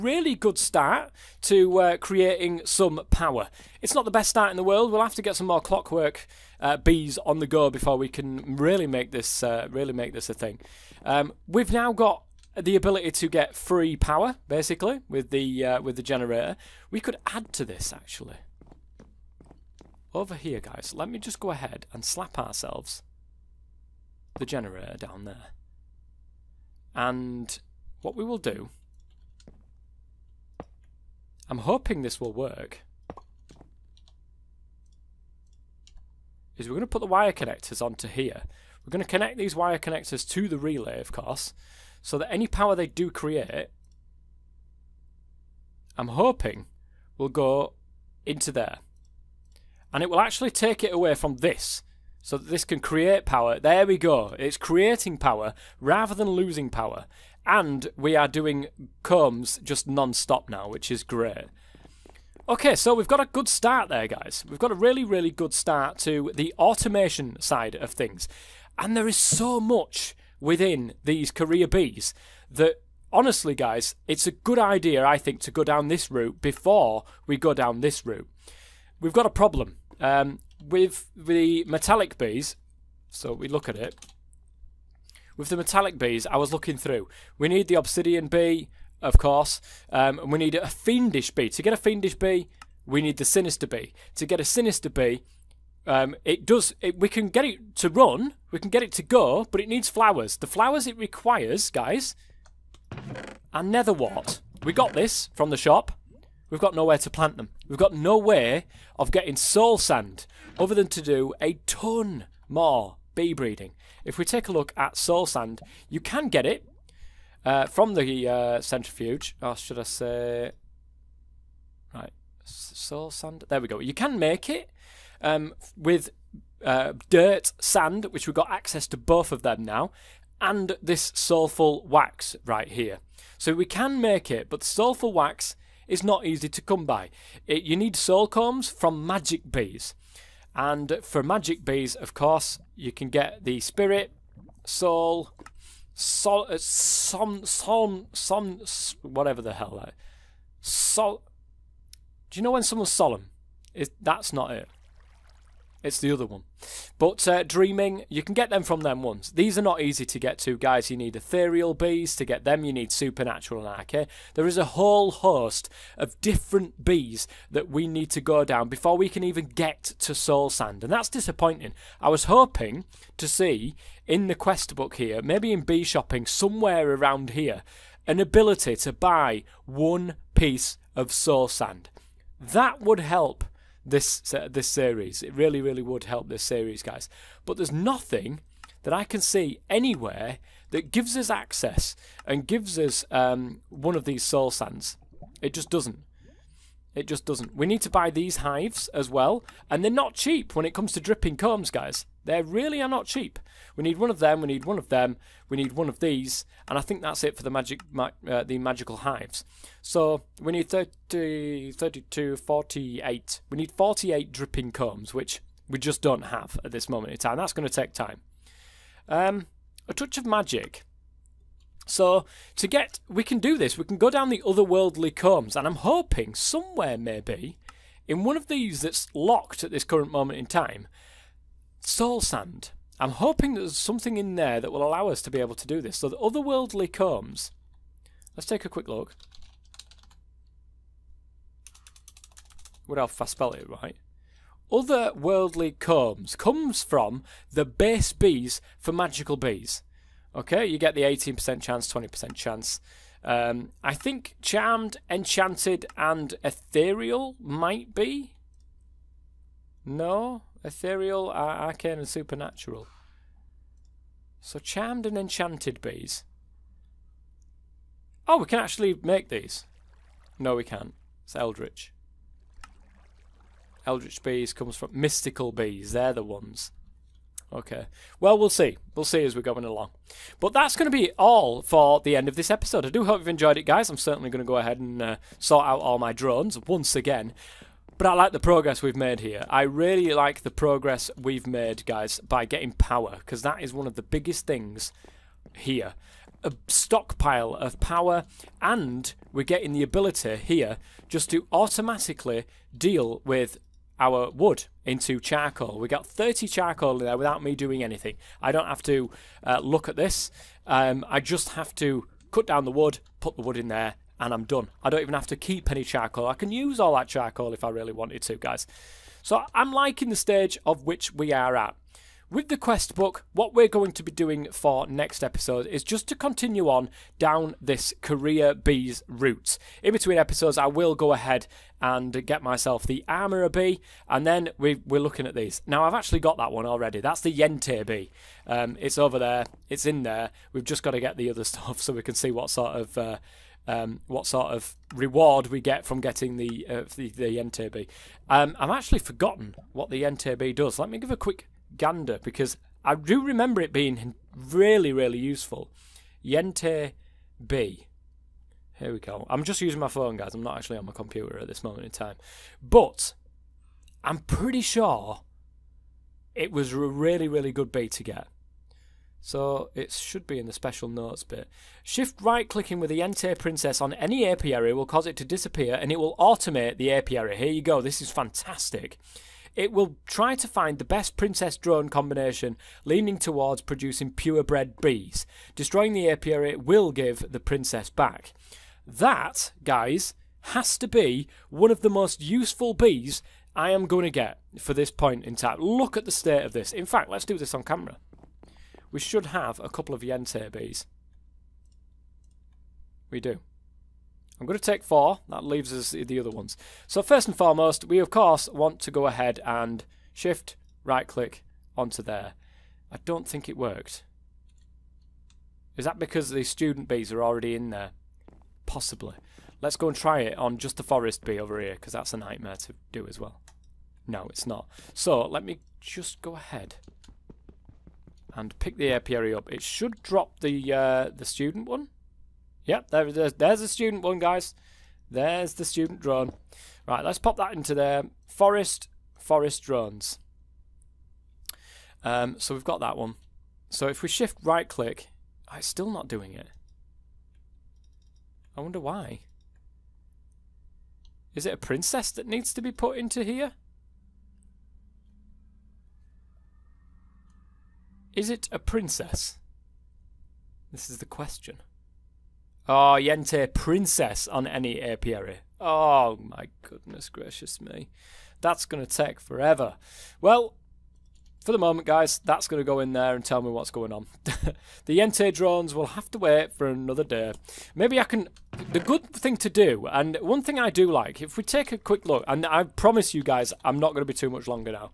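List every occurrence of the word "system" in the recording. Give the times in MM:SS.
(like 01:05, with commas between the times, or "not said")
not said.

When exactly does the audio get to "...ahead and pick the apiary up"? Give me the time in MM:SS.
07:06.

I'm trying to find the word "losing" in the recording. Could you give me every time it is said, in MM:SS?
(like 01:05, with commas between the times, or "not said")
00:56.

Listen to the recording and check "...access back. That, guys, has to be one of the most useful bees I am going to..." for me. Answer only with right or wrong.
wrong.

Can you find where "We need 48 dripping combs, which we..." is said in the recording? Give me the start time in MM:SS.
03:33.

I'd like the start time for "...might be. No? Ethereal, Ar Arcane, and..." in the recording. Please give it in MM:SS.
04:17.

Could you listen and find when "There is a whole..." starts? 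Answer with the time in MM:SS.
02:44.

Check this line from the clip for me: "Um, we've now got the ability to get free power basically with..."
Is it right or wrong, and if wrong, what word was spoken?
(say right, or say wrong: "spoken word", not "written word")
right.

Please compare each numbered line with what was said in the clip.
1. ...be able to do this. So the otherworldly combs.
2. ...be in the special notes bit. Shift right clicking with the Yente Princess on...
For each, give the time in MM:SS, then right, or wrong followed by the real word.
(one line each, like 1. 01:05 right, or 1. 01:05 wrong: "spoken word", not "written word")
1. 03:55 right
2. 06:10 right.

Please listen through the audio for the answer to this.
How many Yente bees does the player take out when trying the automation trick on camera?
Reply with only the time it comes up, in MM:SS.
06:44.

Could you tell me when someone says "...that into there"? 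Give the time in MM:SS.
07:17.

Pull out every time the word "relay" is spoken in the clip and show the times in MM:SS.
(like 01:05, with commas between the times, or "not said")
00:40.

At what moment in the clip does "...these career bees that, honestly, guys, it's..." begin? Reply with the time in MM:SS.
01:11.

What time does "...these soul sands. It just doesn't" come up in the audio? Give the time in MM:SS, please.
03:14.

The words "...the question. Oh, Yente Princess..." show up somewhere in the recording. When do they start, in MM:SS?
07:40.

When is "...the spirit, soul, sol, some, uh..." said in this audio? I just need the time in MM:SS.
02:23.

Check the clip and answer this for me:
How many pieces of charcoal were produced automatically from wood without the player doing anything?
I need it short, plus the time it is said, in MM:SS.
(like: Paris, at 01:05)
30, at 05:06.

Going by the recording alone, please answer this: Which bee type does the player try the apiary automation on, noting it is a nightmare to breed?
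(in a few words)
Forest bee.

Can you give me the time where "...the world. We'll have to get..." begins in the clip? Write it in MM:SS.
00:04.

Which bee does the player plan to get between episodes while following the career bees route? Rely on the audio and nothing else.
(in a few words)
Armorer bee.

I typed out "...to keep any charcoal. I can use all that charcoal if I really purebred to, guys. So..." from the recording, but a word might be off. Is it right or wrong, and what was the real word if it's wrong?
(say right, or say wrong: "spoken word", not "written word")
wrong: "wanted", not "purebred".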